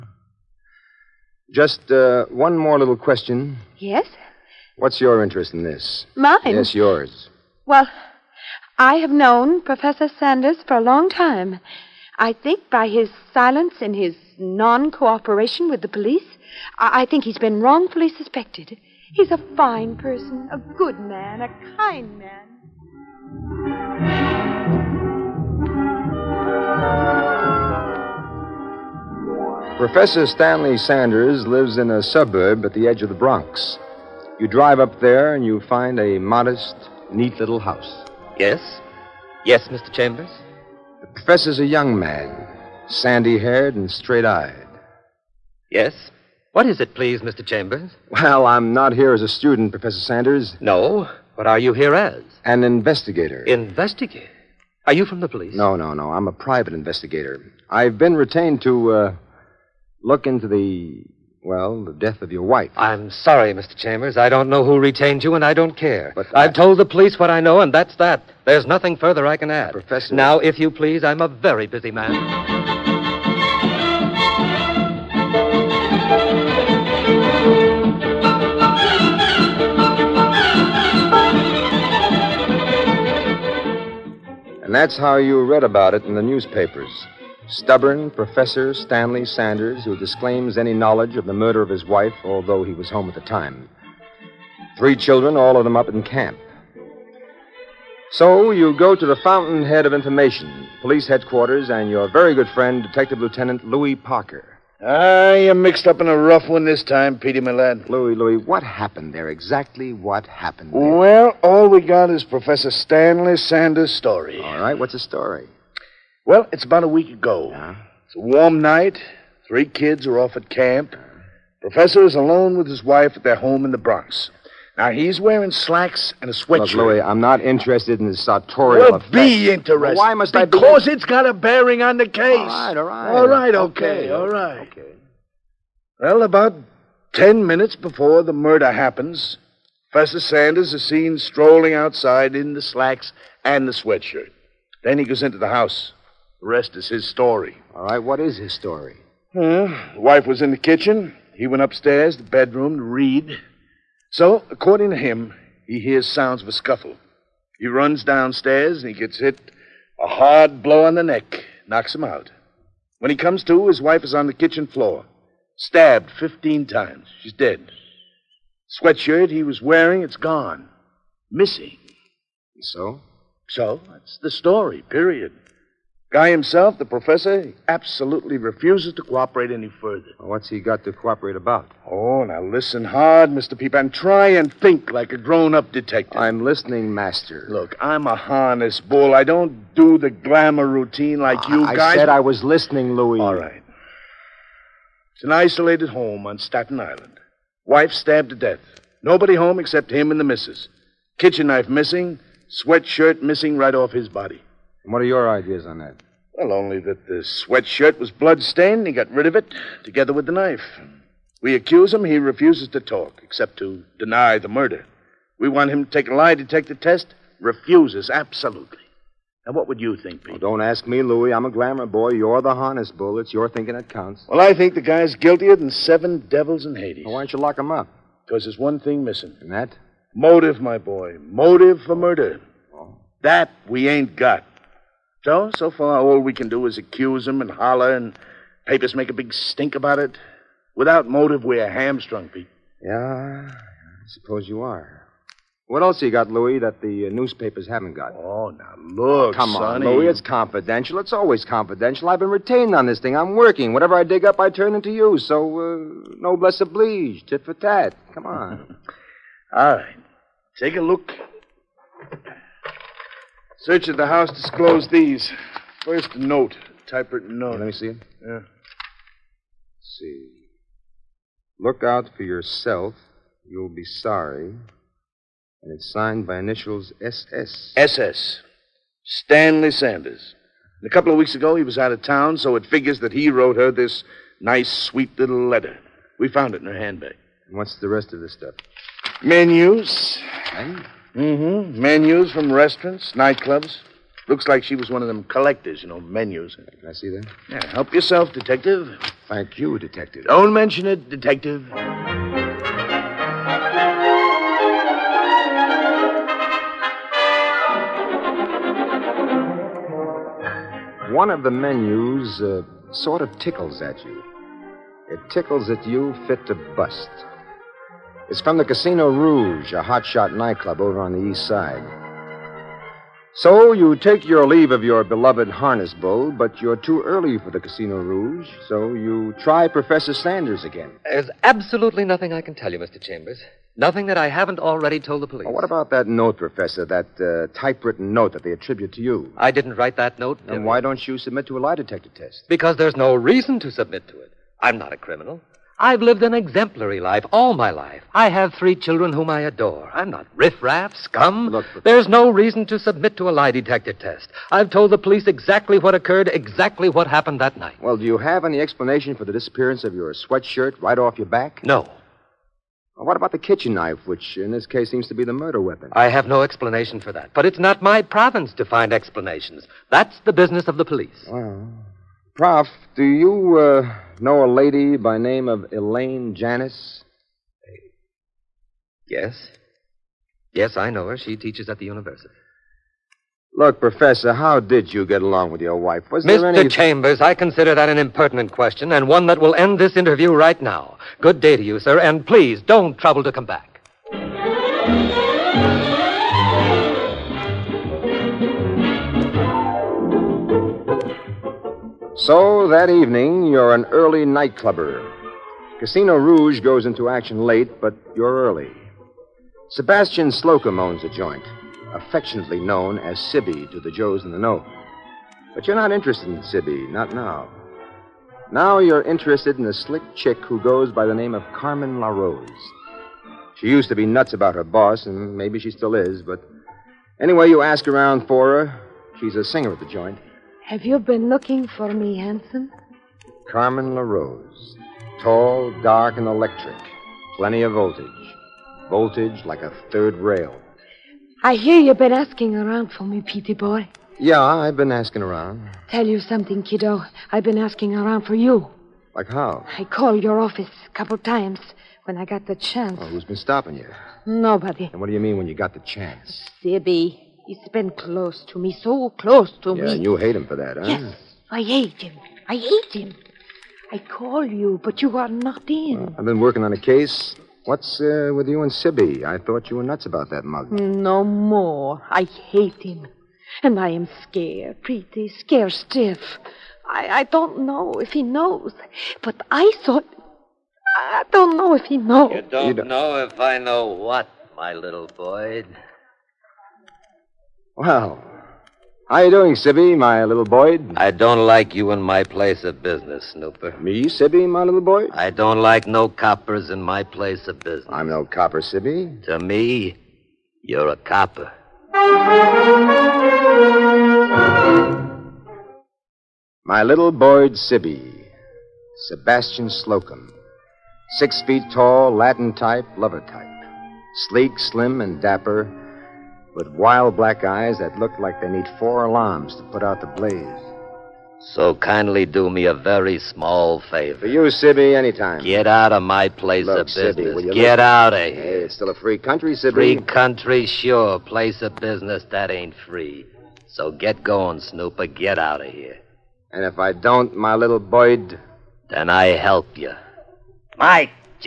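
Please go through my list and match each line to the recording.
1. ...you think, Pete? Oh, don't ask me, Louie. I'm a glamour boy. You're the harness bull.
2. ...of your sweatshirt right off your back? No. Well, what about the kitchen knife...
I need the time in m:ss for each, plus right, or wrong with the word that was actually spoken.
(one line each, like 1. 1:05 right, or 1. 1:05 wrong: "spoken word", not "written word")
1. 3:39 right
2. 5:59 right.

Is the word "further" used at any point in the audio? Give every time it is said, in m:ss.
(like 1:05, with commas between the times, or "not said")
1:08, 2:59.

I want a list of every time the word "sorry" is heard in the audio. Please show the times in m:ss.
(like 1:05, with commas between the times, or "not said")
1:03, 4:33.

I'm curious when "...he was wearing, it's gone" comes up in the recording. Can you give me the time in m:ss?
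2:49.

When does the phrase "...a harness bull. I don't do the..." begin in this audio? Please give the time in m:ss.
3:08.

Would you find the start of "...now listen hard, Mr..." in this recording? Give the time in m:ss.
3:02.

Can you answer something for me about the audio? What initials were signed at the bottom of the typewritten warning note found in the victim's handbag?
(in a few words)
SS.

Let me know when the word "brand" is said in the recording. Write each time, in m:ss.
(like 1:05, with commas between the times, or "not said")
not said.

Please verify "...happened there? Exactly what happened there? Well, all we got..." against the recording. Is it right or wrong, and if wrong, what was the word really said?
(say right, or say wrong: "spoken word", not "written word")
right.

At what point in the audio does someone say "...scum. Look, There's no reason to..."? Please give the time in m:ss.
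5:50.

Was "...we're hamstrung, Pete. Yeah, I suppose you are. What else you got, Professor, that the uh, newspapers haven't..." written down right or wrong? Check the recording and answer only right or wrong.
wrong.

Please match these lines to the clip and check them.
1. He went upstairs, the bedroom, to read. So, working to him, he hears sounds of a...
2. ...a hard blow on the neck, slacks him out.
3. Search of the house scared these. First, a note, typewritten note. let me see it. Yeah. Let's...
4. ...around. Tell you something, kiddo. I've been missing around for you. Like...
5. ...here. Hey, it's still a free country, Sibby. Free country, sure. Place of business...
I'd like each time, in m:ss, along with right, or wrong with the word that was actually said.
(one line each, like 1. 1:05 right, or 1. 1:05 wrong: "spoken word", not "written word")
1. 2:31 wrong: "according", not "working"
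2. 2:39 wrong: "knocks", not "slacks"
3. 4:23 wrong: "disclosed", not "scared"
4. 7:25 wrong: "asking", not "missing"
5. 8:48 right.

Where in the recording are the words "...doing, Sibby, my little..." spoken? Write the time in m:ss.
8:09.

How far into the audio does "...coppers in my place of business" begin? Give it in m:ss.
8:16.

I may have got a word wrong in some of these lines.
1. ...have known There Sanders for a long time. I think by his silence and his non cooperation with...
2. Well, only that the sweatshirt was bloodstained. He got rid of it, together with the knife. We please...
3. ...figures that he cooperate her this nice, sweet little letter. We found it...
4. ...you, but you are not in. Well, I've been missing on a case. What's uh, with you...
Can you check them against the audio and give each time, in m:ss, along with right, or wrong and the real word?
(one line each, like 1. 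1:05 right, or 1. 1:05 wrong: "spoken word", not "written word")
1. 0:08 wrong: "Professor", not "There"
2. 3:26 wrong: "accuse", not "please"
3. 4:42 wrong: "wrote", not "cooperate"
4. 7:44 wrong: "working", not "missing".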